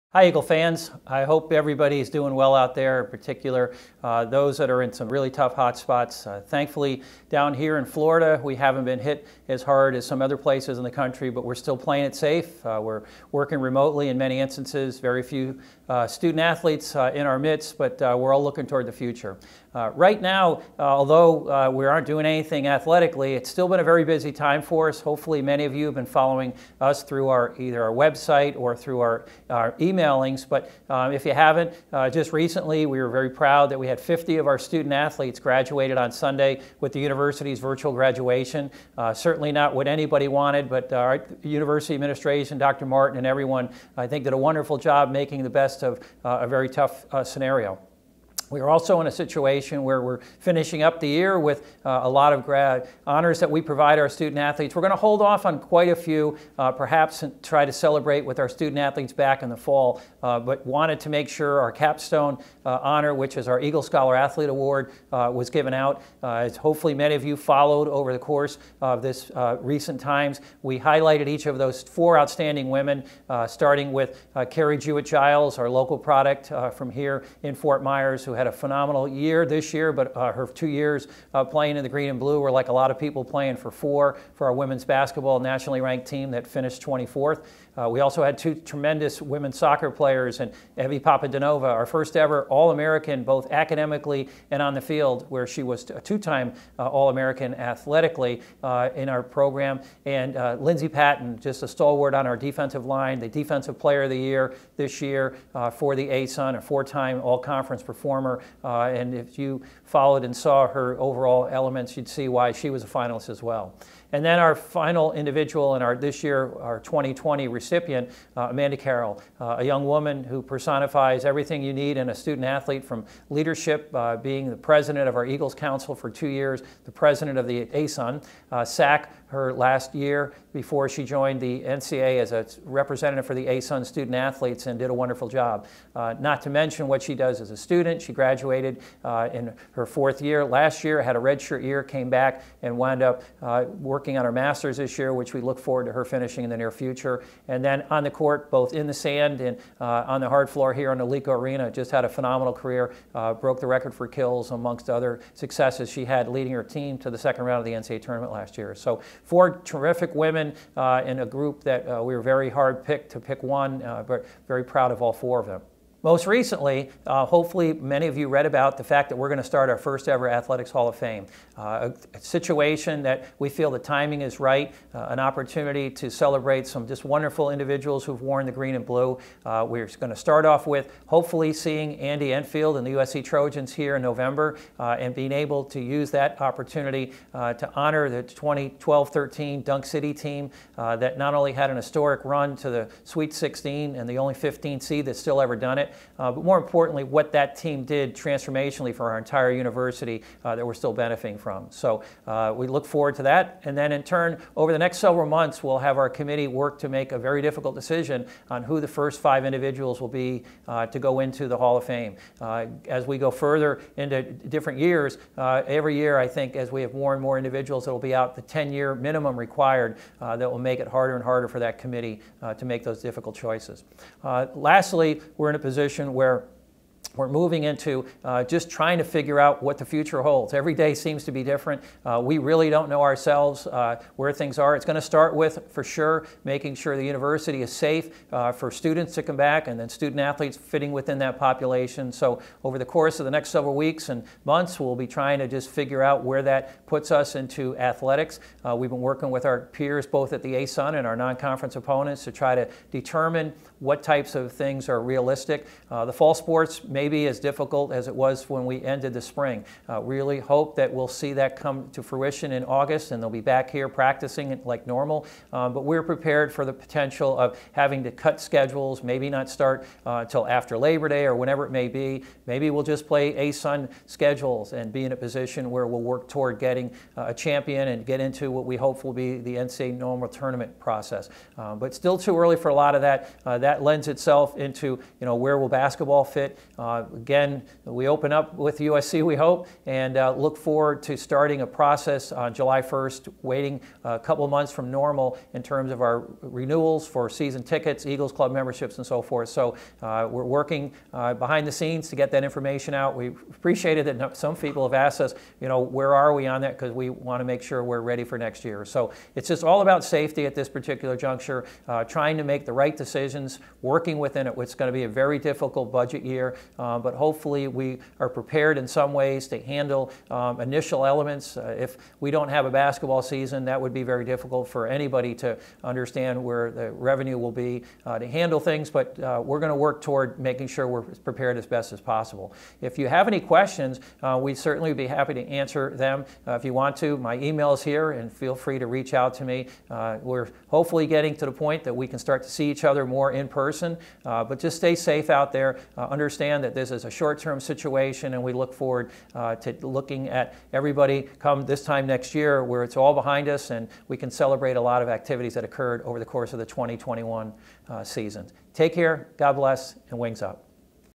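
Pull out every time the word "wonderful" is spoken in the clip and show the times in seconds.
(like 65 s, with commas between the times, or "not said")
44 s, 134 s, 177 s.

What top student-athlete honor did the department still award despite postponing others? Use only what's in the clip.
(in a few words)
Eagle Scholar Athlete Award.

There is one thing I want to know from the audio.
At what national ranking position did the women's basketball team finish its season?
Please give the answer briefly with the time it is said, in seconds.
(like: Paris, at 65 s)
24th, at 86 s.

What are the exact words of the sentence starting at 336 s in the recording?
if you want to, my email is here, and feel free to reach out to me.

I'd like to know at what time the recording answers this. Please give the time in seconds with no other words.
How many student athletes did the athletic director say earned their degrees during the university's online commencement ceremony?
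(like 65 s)
33 s.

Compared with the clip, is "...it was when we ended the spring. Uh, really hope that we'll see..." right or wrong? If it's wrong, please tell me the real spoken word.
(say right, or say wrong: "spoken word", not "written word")
right.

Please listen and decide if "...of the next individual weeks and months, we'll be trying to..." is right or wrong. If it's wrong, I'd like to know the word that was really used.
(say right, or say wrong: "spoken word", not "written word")
wrong: "several", not "individual".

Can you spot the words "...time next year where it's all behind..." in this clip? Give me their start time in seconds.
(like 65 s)
351 s.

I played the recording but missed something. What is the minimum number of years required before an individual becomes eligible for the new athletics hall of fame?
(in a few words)
10.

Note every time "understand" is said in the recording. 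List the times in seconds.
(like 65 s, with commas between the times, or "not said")
325 s, 345 s.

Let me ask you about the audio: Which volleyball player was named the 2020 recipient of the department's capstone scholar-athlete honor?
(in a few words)
Amanda Carroll.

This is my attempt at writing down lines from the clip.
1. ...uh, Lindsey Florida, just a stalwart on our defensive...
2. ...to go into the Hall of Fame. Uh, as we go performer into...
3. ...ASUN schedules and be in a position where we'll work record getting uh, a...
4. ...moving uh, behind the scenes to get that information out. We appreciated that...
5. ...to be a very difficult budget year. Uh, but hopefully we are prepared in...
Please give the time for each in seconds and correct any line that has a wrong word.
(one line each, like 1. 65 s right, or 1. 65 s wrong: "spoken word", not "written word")
1. 100 s wrong: "Patton", not "Florida"
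2. 210 s wrong: "further", not "performer"
3. 273 s wrong: "toward", not "record"
4. 300 s wrong: "working", not "moving"
5. 314 s right.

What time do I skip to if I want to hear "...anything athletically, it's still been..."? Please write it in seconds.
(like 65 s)
22 s.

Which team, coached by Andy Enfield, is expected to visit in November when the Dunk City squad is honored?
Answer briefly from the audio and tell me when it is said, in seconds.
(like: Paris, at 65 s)
USC Trojans, at 182 s.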